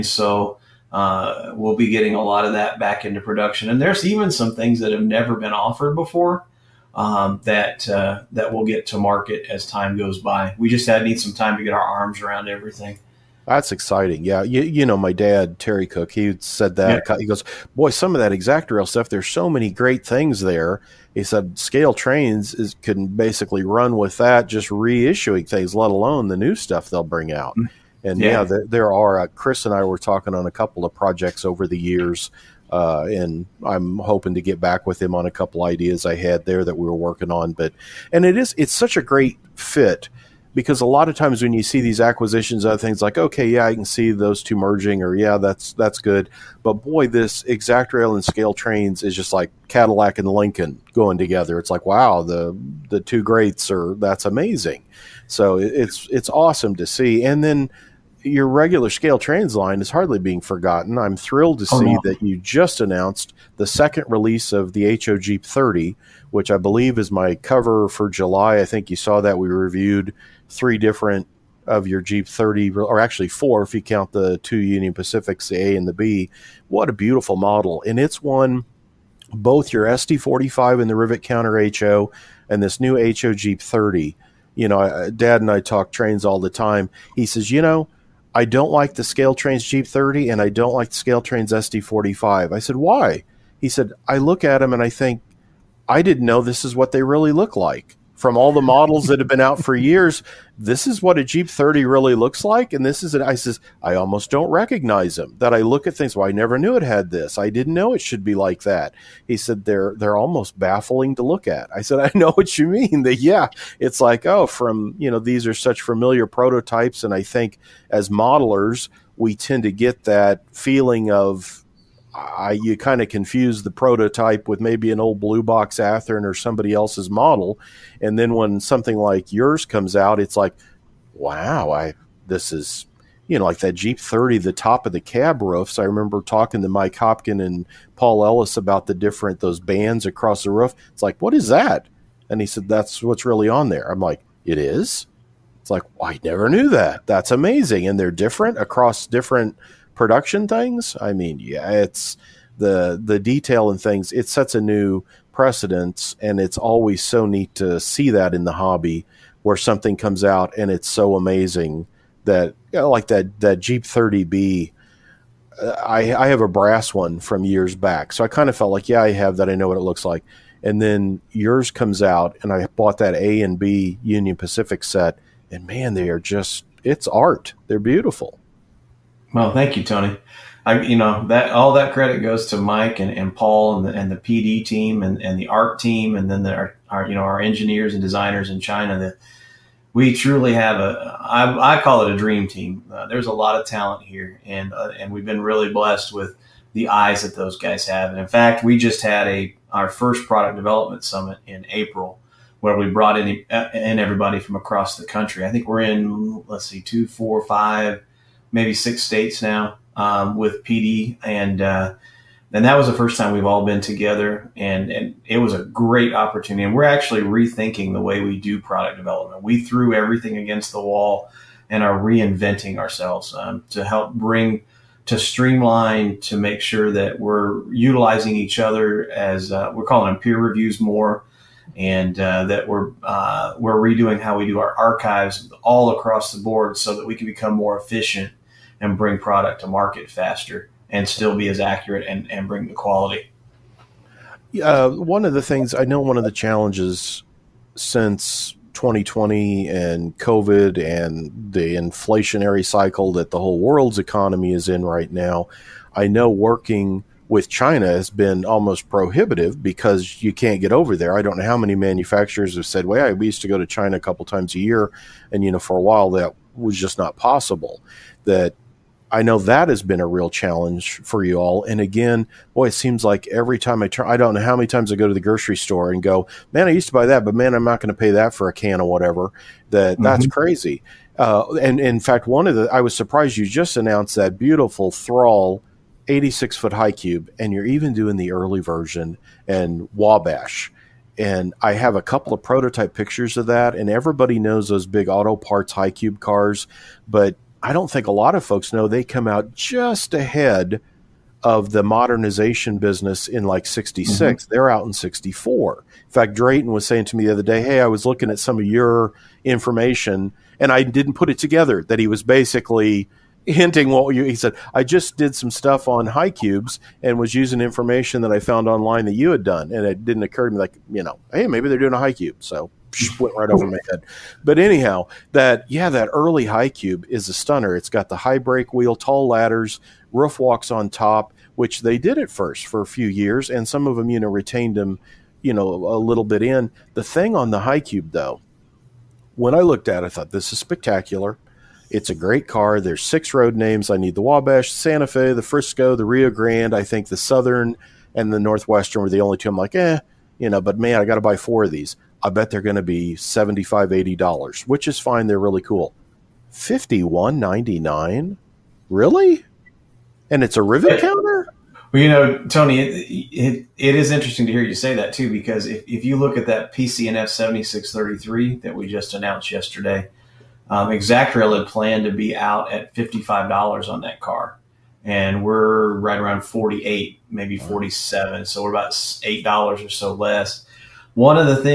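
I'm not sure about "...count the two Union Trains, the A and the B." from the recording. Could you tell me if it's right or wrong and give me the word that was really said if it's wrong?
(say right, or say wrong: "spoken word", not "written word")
wrong: "Pacifics", not "Trains".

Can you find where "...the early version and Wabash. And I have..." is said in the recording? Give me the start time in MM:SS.
04:48.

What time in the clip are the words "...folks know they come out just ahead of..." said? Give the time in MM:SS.
04:58.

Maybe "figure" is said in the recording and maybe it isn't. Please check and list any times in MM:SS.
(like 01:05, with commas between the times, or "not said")
not said.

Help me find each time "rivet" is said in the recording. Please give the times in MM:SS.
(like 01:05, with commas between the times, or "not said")
01:20, 06:00.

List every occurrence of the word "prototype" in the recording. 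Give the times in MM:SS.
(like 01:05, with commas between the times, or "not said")
01:56, 02:03, 04:52.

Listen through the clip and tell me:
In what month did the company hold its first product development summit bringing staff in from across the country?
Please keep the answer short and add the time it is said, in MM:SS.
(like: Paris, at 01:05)
April, at 03:21.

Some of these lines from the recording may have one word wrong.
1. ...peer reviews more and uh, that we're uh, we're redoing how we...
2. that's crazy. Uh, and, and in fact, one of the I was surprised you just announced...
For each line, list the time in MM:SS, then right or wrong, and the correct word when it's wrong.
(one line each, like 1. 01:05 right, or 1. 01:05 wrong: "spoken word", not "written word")
1. 03:50 right
2. 04:40 right.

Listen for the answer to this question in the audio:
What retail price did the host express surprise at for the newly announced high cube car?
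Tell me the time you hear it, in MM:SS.
05:56.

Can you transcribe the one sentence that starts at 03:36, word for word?
And we're actually rethinking the way we do product development.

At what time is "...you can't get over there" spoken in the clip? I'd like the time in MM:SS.
04:20.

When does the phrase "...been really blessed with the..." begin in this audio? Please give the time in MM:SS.
03:15.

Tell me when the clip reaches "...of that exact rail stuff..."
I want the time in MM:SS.
00:18.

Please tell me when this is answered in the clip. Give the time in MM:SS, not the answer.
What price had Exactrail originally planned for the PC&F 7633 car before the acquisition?
06:12.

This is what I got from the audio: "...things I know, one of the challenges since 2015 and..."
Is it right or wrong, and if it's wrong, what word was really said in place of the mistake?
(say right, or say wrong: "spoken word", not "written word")
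wrong: "2020", not "2015".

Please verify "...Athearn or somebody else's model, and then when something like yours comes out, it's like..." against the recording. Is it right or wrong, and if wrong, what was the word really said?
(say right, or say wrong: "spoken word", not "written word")
right.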